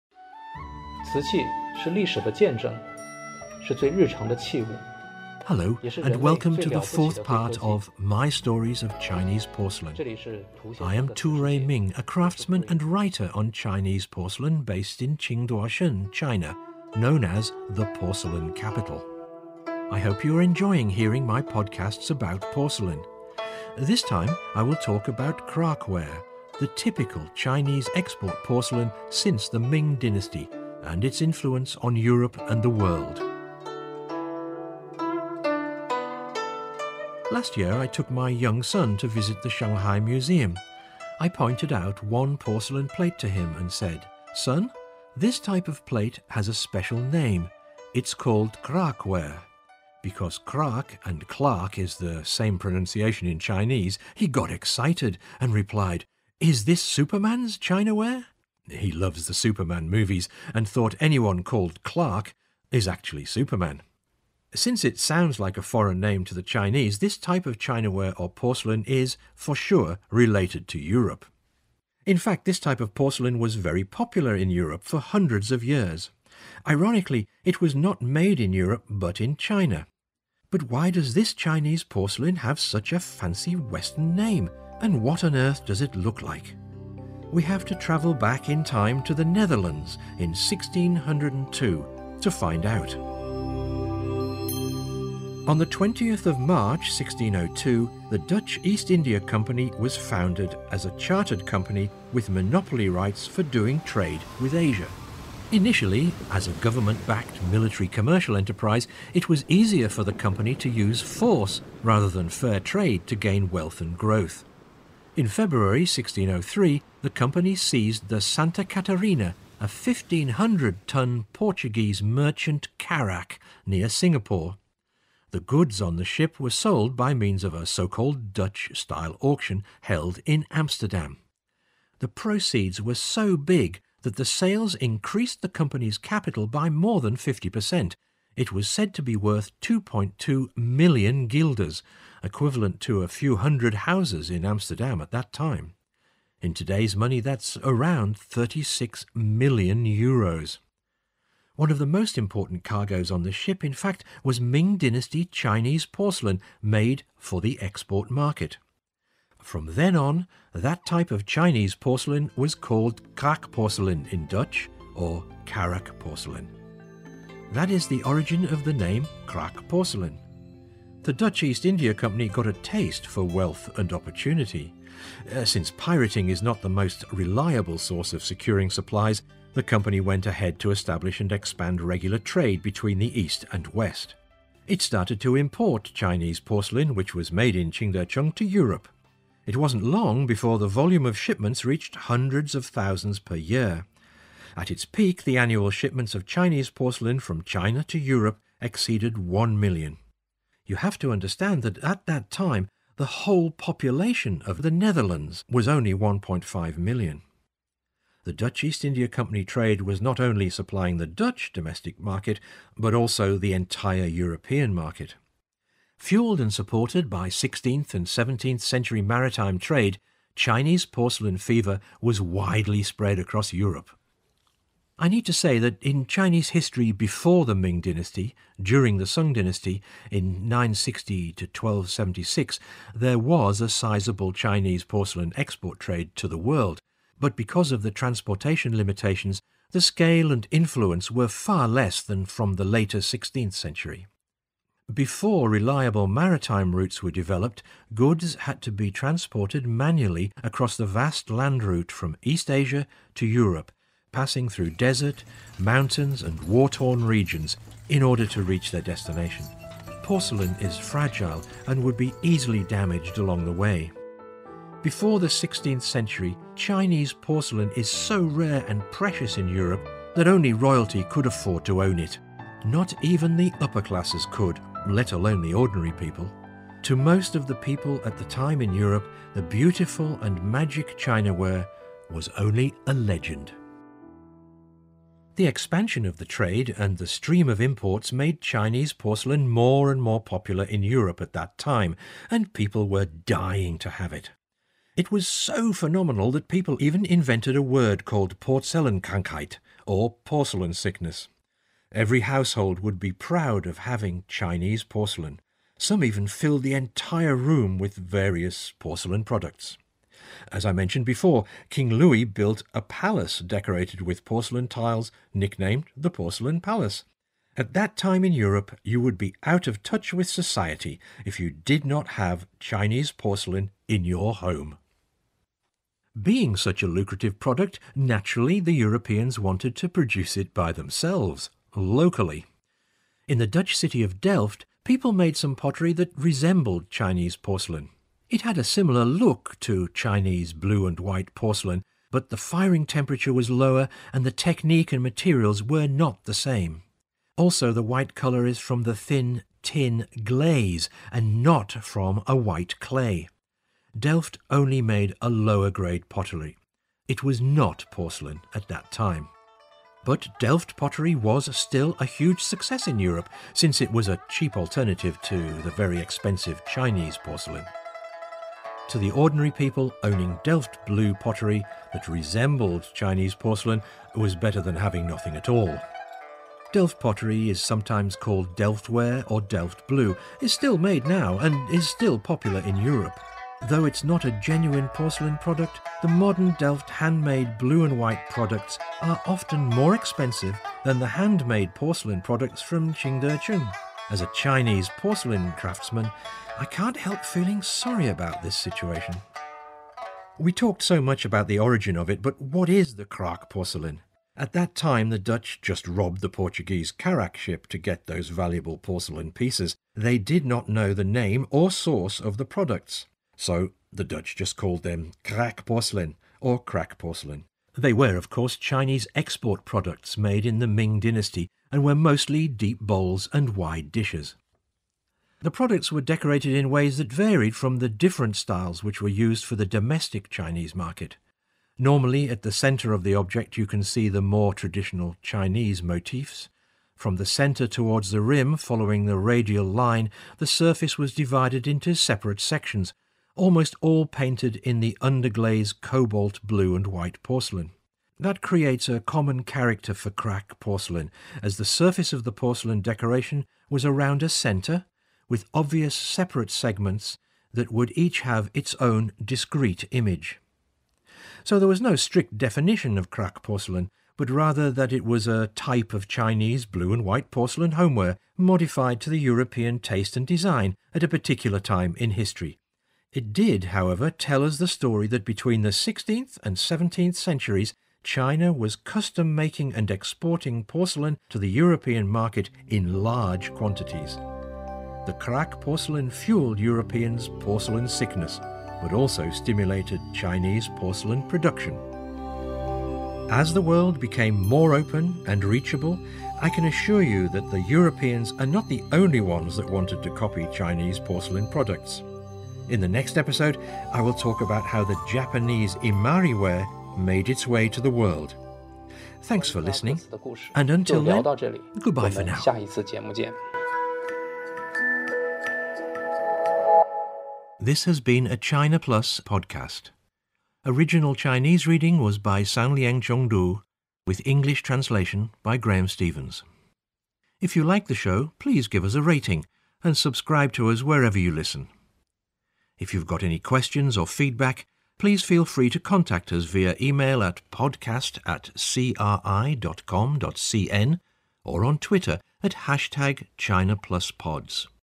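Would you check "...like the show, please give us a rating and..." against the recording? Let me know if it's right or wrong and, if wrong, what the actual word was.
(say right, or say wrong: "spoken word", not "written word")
right.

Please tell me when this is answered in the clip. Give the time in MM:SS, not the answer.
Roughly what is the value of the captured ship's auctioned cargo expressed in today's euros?
02:28.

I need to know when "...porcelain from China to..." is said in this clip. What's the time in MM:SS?
03:16.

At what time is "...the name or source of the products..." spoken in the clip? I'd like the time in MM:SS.
06:50.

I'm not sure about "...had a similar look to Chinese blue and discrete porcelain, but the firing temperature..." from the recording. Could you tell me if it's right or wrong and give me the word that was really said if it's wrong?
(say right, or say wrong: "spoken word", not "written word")
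wrong: "white", not "discrete".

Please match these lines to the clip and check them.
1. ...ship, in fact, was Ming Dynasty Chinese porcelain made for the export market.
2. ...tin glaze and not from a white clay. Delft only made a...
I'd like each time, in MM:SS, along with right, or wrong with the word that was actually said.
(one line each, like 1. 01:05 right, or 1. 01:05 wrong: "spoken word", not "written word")
1. 02:33 right
2. 05:49 right.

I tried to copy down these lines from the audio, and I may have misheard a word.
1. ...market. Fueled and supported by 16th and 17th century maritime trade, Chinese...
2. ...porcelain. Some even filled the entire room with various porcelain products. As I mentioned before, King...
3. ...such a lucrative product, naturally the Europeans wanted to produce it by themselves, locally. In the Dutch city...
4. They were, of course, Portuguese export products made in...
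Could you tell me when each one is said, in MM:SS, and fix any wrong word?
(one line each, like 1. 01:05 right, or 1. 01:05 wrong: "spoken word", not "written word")
1. 03:34 right
2. 05:04 right
3. 05:26 right
4. 06:57 wrong: "Chinese", not "Portuguese".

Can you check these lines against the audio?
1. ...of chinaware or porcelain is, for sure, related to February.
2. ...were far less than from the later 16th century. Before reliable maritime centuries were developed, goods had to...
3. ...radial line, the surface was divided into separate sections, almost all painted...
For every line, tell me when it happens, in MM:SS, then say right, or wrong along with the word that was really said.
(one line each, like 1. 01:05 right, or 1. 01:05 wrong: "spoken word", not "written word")
1. 01:07 wrong: "Europe", not "February"
2. 04:01 wrong: "routes", not "centuries"
3. 07:19 right.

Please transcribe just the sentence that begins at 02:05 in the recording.
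The goods on the ship were sold by means of a so called Dutch style auction held in Amsterdam.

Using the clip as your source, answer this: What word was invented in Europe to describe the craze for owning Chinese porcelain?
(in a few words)
Porzellankrankheit.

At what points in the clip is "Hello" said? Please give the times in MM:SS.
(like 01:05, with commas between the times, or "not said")
00:05.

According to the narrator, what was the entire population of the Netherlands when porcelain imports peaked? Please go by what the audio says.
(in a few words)
1.5 million.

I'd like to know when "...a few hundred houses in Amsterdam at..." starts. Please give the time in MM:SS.
02:23.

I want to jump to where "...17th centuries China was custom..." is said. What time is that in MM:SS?
07:56.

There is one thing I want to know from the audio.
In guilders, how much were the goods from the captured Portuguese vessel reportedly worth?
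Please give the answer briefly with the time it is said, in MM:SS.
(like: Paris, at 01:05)
2.2 million guilders, at 02:19.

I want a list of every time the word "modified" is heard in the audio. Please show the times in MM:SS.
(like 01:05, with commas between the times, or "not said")
07:48.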